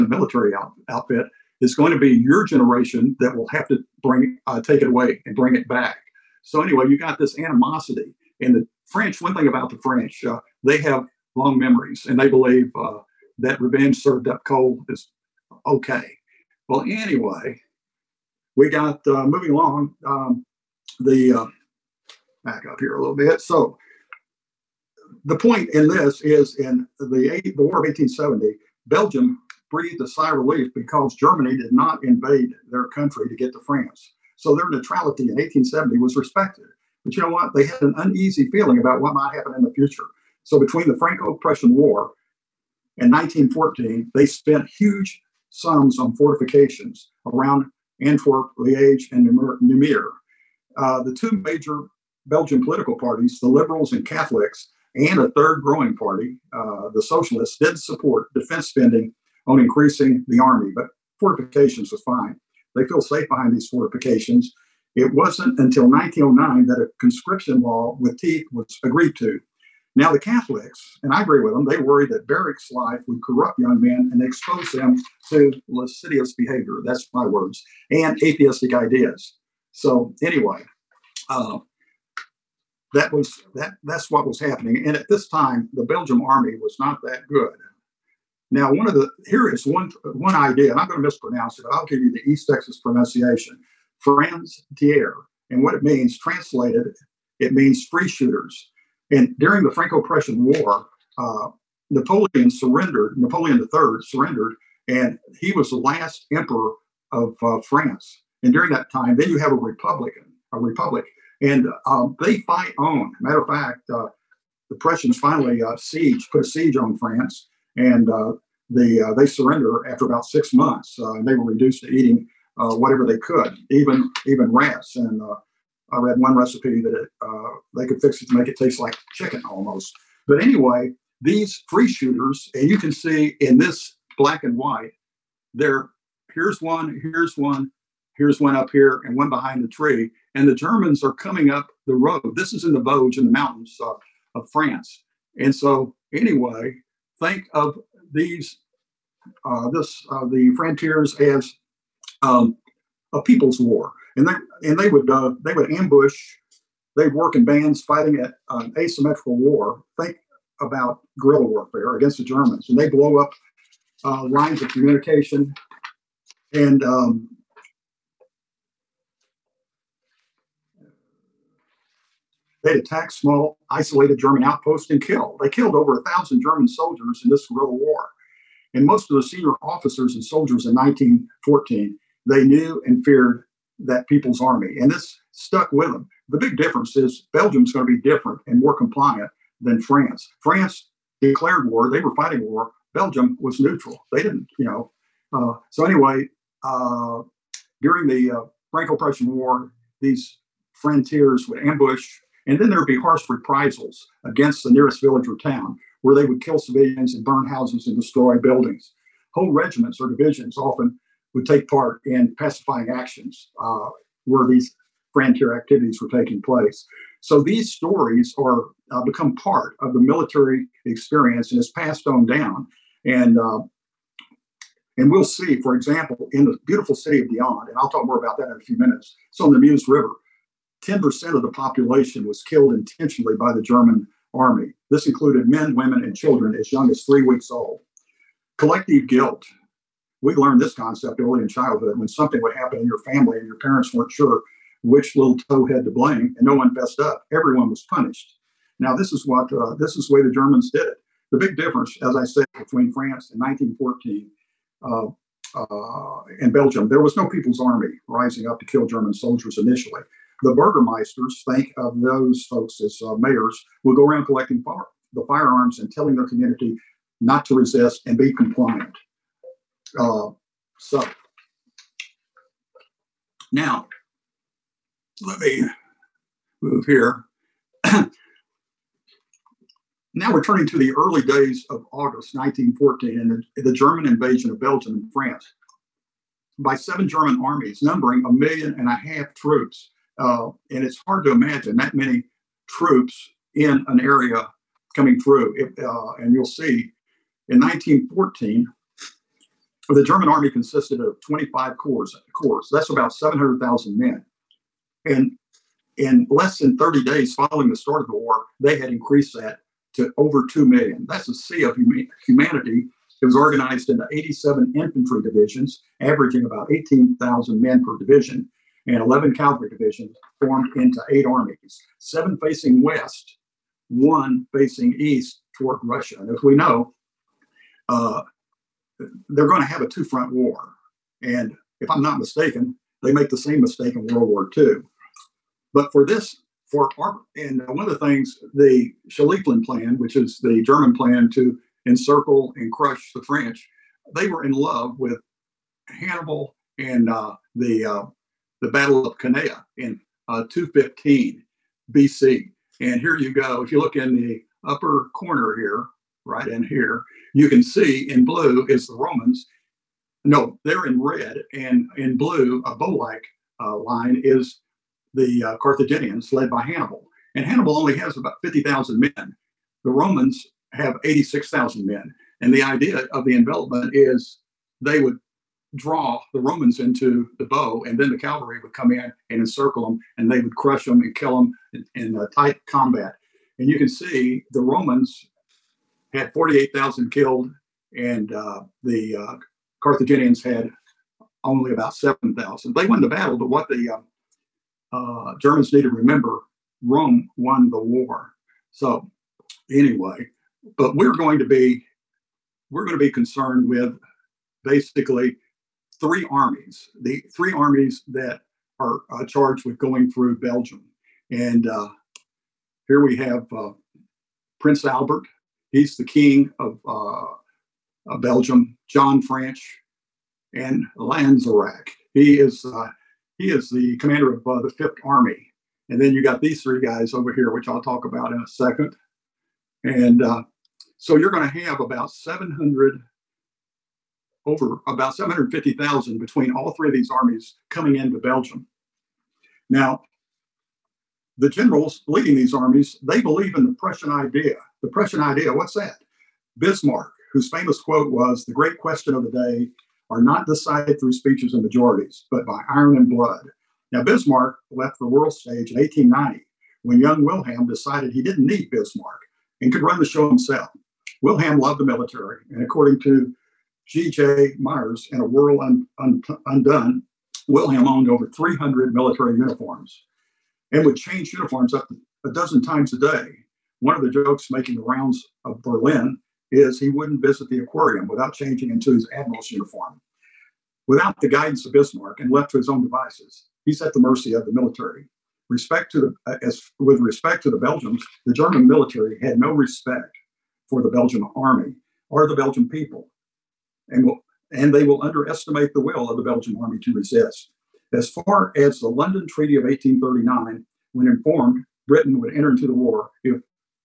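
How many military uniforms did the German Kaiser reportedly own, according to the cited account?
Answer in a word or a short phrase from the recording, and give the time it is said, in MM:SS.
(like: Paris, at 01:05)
over 300, at 07:48.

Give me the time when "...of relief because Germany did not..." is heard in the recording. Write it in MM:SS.
00:30.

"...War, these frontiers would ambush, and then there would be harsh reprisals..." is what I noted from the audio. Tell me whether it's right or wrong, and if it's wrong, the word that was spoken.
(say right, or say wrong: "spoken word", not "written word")
right.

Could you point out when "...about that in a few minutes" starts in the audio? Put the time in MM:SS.
03:48.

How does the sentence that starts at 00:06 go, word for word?
So anyway, you got this animosity, and the French.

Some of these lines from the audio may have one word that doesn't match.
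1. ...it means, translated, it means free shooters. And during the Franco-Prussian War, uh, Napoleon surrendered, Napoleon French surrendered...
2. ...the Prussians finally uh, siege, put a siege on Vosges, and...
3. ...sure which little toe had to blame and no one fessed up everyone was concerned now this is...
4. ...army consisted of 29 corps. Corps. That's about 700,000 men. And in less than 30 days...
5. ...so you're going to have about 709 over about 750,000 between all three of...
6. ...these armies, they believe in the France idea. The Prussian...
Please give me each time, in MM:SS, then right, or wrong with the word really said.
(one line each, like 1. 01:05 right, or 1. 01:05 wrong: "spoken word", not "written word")
1. 01:35 wrong: "III", not "French"
2. 01:54 wrong: "France", not "Vosges"
3. 04:04 wrong: "punished", not "concerned"
4. 05:00 wrong: "25", not "29"
5. 07:10 wrong: "700", not "709"
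6. 07:22 wrong: "Prussian", not "France".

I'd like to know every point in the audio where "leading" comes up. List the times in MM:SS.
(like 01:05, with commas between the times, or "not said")
07:22.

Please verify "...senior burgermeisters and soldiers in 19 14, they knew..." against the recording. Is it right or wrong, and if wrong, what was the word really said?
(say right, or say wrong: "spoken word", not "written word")
wrong: "officers", not "burgermeisters".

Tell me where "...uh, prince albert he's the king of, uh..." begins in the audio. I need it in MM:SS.
06:53.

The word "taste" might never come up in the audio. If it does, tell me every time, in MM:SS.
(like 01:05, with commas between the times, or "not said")
02:08.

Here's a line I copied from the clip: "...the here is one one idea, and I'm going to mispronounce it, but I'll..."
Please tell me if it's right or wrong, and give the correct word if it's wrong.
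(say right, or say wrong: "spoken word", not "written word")
right.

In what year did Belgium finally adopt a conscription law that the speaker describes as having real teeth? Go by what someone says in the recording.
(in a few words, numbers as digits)
1909.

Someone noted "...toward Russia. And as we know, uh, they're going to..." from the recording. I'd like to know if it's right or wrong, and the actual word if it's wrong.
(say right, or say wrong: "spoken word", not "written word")
right.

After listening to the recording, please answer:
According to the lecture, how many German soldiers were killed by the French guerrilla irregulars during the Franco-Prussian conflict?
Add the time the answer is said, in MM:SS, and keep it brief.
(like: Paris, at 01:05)
over a thousand, at 02:55.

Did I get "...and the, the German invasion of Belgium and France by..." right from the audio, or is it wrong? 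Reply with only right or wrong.
right.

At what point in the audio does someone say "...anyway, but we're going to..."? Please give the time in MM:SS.
06:39.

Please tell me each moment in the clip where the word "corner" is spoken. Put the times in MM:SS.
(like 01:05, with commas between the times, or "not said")
05:55.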